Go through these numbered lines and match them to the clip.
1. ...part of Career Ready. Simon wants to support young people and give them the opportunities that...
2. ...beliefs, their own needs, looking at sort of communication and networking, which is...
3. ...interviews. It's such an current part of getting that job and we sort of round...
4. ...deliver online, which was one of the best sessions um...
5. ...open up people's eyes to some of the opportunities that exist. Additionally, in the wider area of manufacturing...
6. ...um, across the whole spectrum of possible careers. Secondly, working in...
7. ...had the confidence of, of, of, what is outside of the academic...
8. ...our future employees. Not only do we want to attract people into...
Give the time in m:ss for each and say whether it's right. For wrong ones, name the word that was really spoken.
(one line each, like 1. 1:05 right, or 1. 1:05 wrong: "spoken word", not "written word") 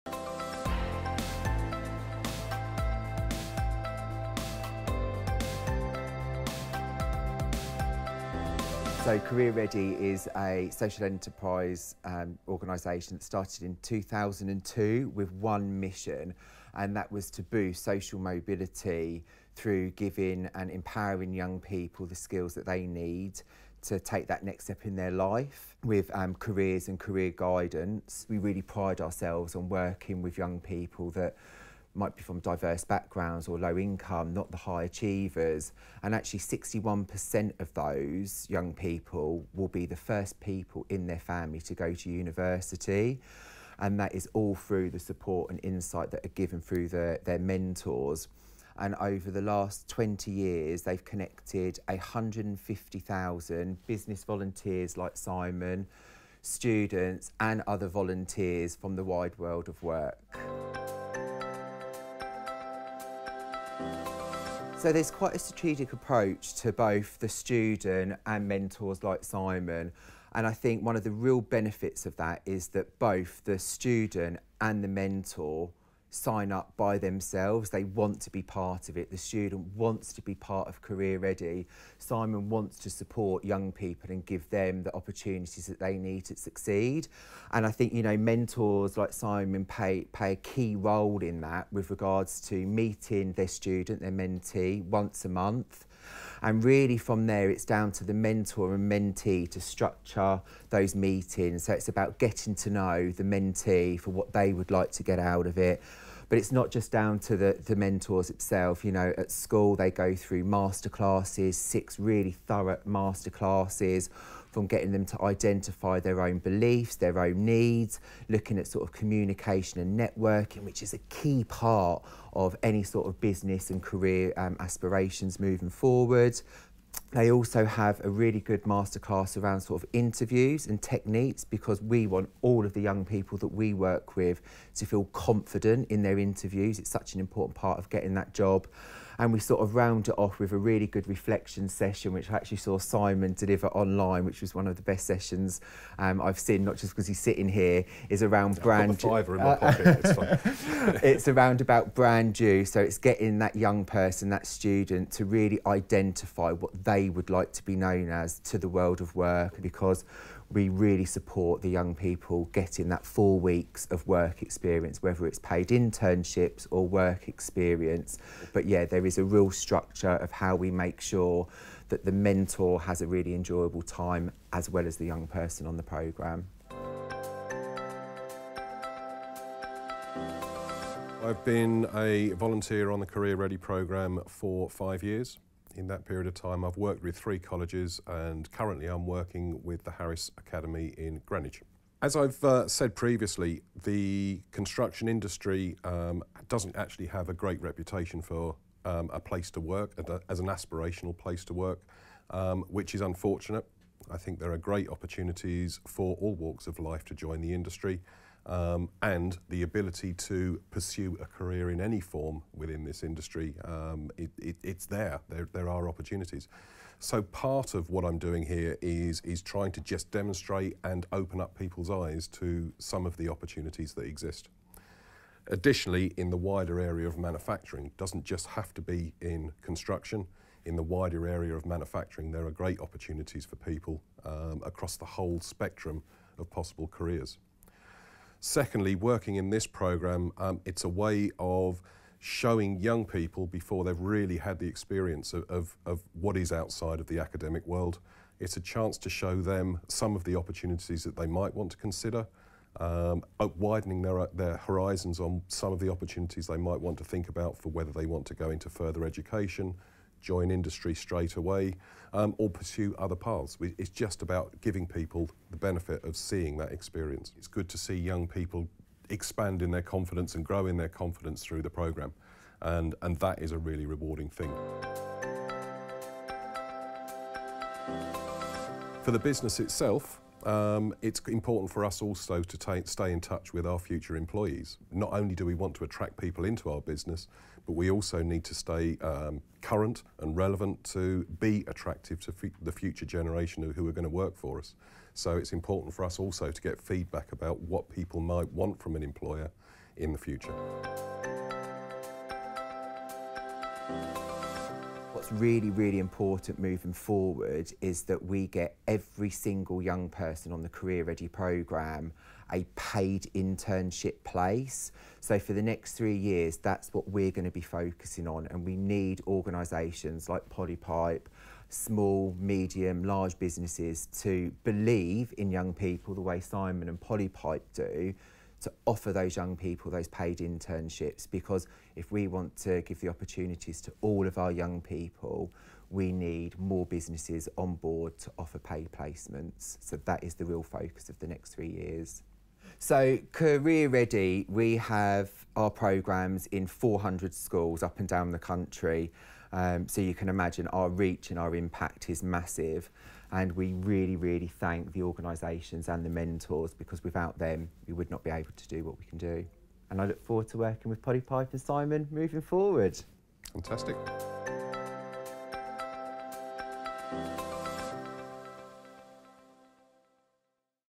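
1. 1:20 right
2. 1:56 right
3. 2:16 wrong: "important", not "current"
4. 2:23 right
5. 3:41 right
6. 3:54 right
7. 4:04 wrong: "experience", not "confidence"
8. 4:43 right.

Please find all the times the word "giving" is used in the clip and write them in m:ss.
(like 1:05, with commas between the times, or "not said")
0:19, 4:24.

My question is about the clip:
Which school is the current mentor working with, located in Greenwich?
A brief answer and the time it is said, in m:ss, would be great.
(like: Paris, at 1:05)
Harris Academy, at 3:09.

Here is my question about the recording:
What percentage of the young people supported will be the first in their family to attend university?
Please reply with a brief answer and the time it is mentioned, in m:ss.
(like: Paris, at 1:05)
61%, at 0:36.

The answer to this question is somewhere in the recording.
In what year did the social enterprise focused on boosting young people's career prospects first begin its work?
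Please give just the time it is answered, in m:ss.
0:13.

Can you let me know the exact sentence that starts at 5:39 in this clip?
So that is the real focus of the next three years.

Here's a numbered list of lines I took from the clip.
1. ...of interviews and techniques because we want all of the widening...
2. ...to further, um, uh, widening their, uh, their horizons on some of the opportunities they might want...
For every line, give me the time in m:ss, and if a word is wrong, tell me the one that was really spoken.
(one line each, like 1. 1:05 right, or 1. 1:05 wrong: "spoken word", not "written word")
1. 2:09 wrong: "young", not "widening"
2. 4:11 wrong: "consider", not "further".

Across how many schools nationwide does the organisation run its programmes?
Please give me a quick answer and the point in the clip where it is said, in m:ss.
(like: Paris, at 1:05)
400, at 5:46.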